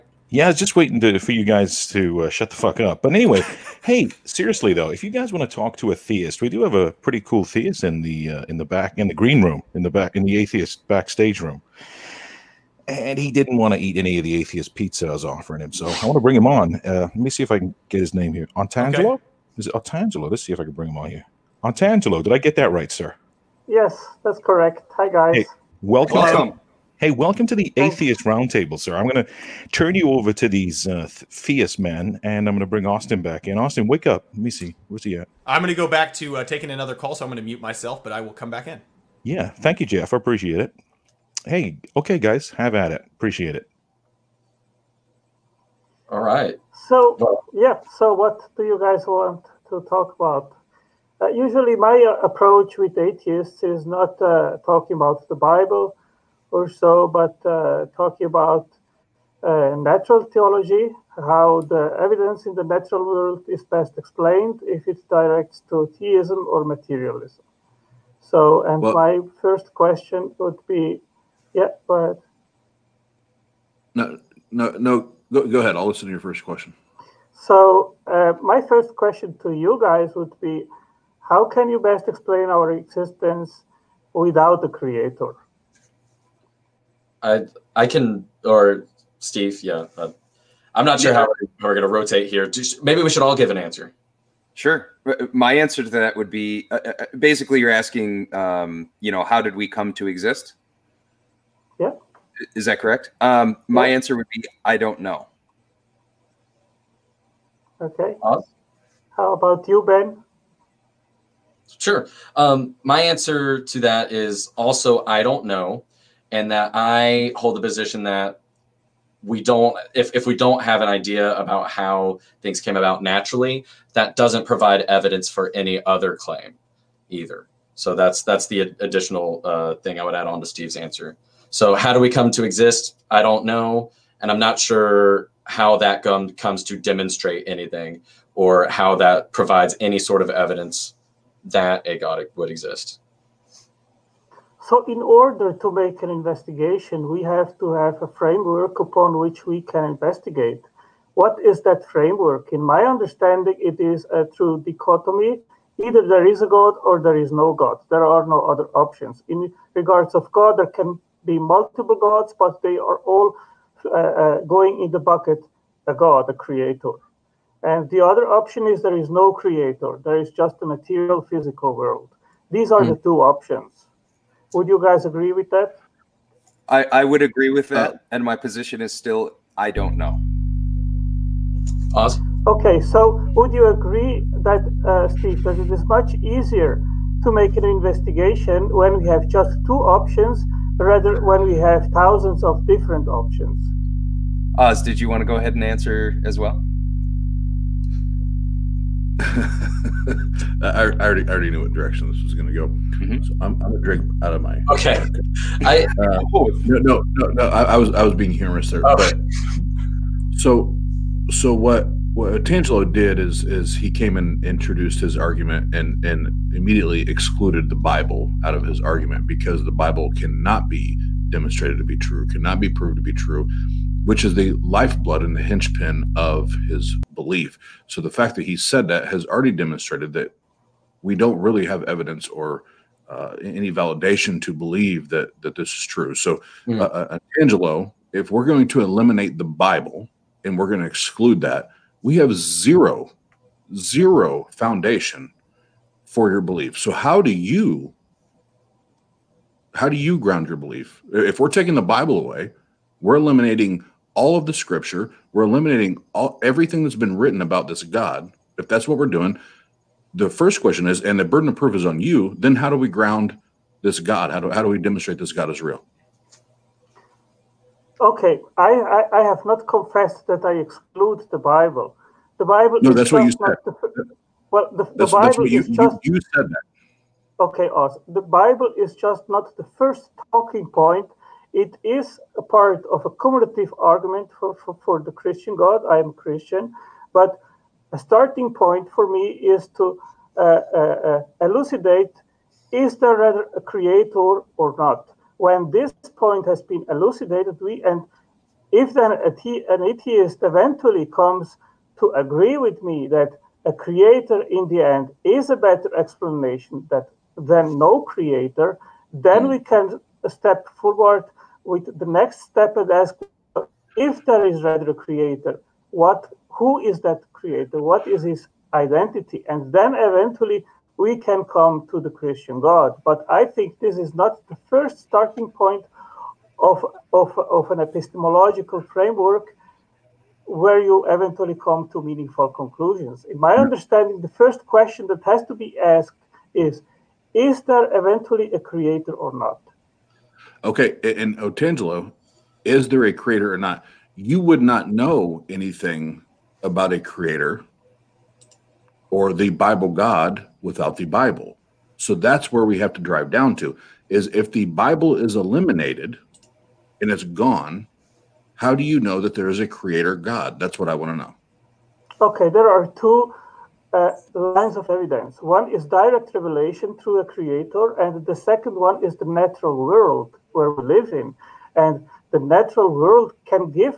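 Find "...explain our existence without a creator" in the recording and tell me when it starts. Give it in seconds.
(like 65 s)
82 s.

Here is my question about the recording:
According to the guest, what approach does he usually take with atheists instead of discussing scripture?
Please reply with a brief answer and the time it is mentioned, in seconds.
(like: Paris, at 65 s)
natural theology, at 59 s.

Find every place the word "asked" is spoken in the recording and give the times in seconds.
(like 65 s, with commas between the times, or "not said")
335 s.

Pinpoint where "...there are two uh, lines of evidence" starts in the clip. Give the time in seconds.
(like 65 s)
362 s.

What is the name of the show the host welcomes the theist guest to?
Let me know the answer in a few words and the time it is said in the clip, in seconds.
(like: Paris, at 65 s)
Atheist Roundtable, at 27 s.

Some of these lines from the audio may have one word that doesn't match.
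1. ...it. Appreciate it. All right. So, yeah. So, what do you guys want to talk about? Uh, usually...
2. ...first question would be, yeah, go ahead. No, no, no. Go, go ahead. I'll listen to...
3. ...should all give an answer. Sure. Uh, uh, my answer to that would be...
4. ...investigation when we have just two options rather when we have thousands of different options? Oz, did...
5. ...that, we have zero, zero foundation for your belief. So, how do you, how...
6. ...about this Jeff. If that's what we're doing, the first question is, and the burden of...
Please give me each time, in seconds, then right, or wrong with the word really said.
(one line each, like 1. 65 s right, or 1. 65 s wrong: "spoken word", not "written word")
1. 42 s right
2. 69 s right
3. 93 s right
4. 187 s right
5. 241 s right
6. 257 s wrong: "God", not "Jeff".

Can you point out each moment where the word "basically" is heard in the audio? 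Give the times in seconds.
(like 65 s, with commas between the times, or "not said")
97 s.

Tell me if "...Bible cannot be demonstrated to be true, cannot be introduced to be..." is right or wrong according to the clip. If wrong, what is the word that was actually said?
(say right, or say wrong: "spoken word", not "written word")
wrong: "proved", not "introduced".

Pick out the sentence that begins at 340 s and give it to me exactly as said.
Okay, and Otangelo, is there a creator or not?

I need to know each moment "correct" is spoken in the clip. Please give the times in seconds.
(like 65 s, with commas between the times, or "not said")
24 s, 102 s.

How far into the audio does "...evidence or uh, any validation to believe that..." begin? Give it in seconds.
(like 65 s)
231 s.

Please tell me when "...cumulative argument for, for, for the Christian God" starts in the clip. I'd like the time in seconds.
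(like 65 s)
283 s.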